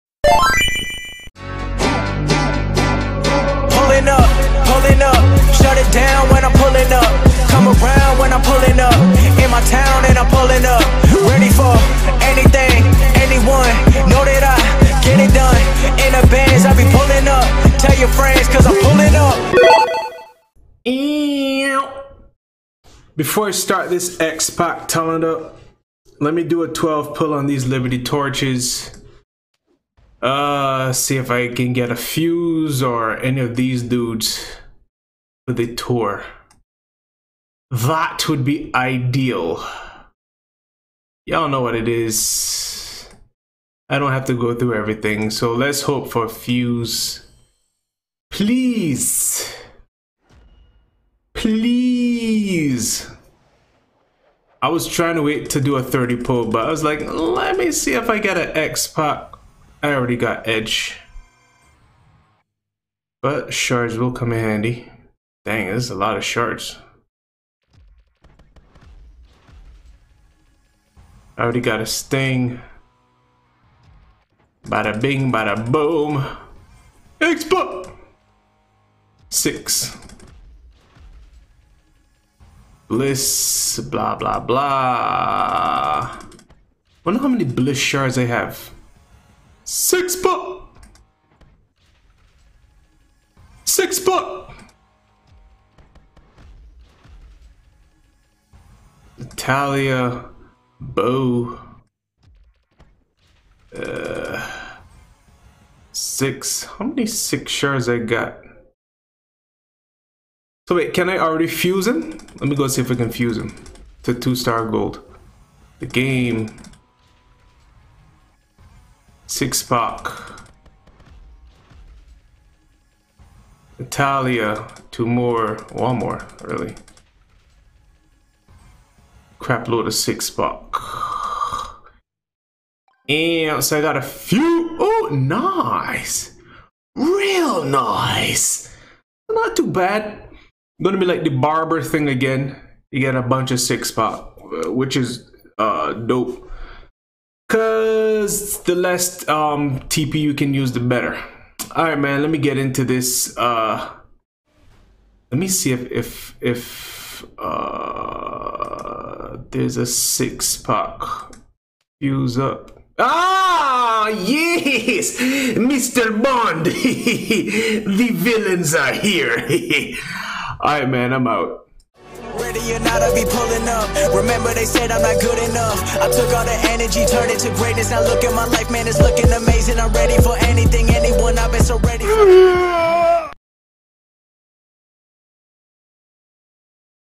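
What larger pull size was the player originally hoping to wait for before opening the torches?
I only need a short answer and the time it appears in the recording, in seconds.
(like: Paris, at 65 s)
30, at 55 s.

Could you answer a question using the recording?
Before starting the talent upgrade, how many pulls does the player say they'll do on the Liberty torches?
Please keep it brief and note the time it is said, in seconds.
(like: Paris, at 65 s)
12, at 26 s.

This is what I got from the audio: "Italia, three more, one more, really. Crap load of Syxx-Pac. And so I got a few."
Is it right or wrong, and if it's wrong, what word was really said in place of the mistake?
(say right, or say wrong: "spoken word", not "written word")
wrong: "two", not "three".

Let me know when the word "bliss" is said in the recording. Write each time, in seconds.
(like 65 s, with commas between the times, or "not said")
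82 s, 87 s.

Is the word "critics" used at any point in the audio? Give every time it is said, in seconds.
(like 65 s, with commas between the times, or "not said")
not said.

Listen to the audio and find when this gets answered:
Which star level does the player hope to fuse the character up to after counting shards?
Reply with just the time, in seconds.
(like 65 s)
114 s.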